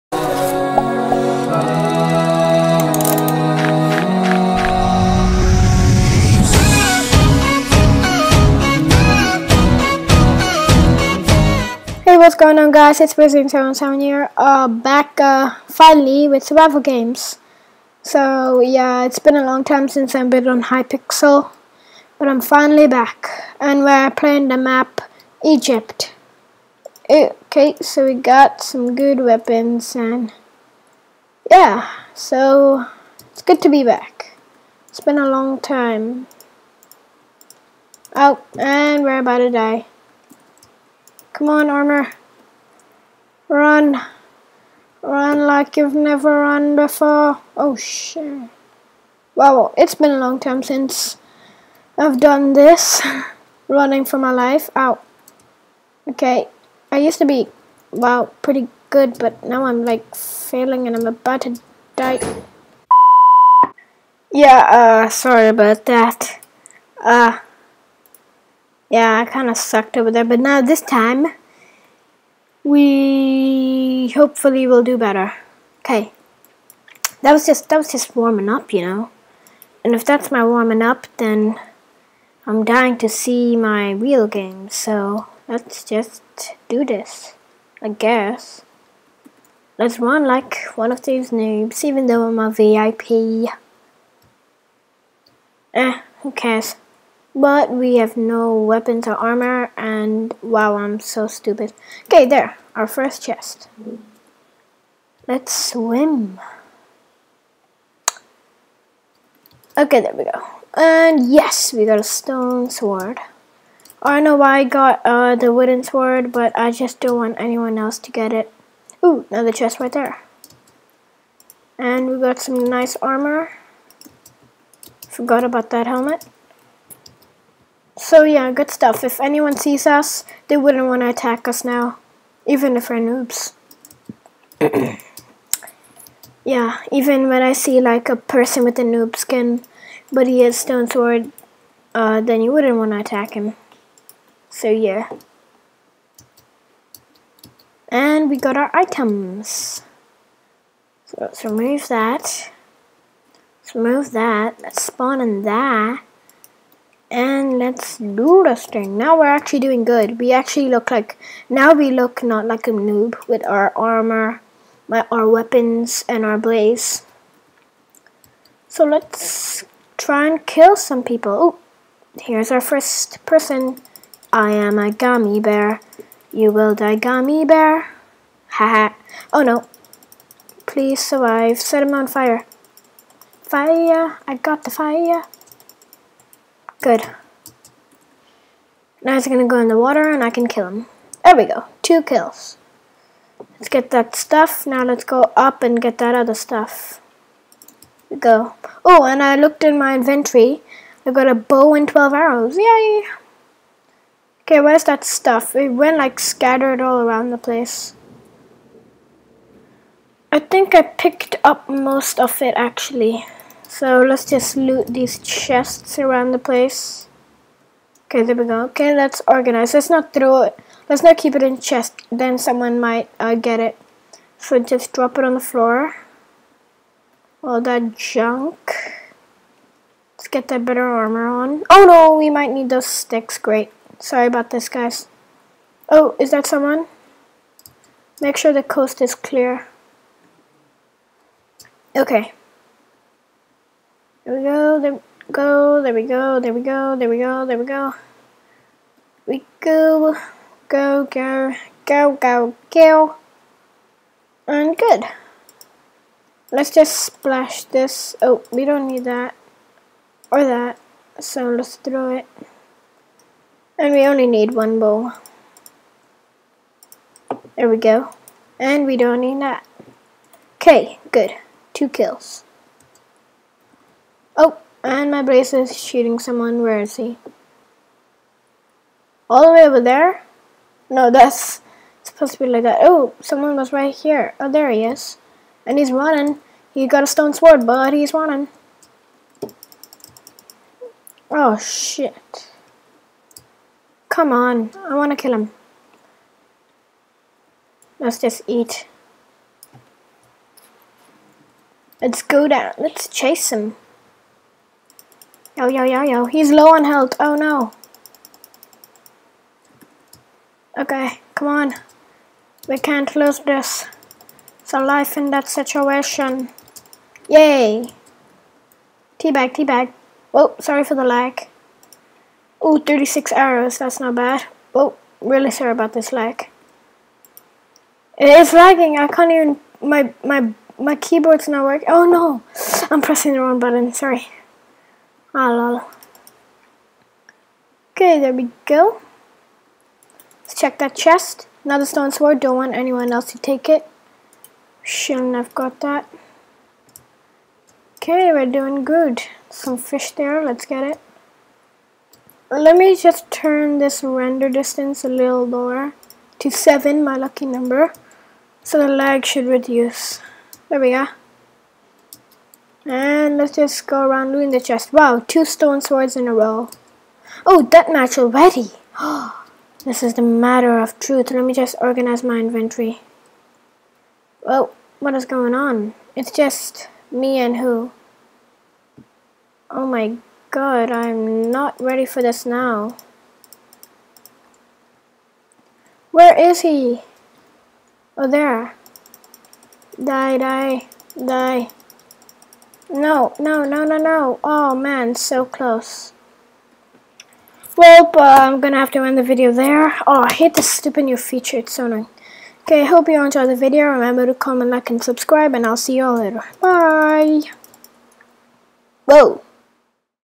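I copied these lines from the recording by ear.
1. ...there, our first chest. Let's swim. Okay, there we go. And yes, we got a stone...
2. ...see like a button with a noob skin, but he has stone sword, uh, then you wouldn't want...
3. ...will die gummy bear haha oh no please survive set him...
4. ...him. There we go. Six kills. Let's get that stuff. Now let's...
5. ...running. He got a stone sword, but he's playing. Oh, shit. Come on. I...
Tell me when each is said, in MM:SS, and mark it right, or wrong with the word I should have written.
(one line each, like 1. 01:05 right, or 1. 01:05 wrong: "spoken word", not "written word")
1. 01:42 right
2. 02:17 wrong: "person", not "button"
3. 02:56 right
4. 03:10 wrong: "Two", not "Six"
5. 04:45 wrong: "running", not "playing".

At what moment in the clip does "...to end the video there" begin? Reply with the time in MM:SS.
06:38.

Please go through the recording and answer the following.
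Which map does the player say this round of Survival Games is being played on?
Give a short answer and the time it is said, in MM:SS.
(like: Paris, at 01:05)
Egypt, at 00:25.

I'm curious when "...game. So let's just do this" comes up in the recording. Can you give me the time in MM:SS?
01:24.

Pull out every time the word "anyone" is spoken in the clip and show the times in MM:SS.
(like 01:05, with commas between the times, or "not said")
01:57, 02:09, 05:42.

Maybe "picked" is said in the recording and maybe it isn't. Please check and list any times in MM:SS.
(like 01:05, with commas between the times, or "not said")
03:30.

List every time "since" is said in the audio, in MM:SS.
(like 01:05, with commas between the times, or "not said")
00:19, 00:50.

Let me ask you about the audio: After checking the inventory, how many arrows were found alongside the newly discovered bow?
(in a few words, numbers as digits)
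12.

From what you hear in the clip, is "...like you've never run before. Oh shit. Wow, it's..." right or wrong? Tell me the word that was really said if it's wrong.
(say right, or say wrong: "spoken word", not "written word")
right.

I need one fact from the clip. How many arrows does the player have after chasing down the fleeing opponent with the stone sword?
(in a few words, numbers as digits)
36.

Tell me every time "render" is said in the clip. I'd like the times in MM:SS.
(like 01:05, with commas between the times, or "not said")
05:54.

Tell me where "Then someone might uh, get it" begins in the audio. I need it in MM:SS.
03:42.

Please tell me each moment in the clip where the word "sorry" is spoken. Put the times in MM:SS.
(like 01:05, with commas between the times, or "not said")
01:05, 03:53, 05:20, 05:25, 05:33.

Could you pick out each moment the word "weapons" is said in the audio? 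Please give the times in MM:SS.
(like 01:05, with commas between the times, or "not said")
00:29, 01:38, 02:45.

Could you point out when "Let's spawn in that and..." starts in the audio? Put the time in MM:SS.
02:34.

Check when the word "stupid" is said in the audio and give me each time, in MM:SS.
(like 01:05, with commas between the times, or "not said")
01:41, 06:40.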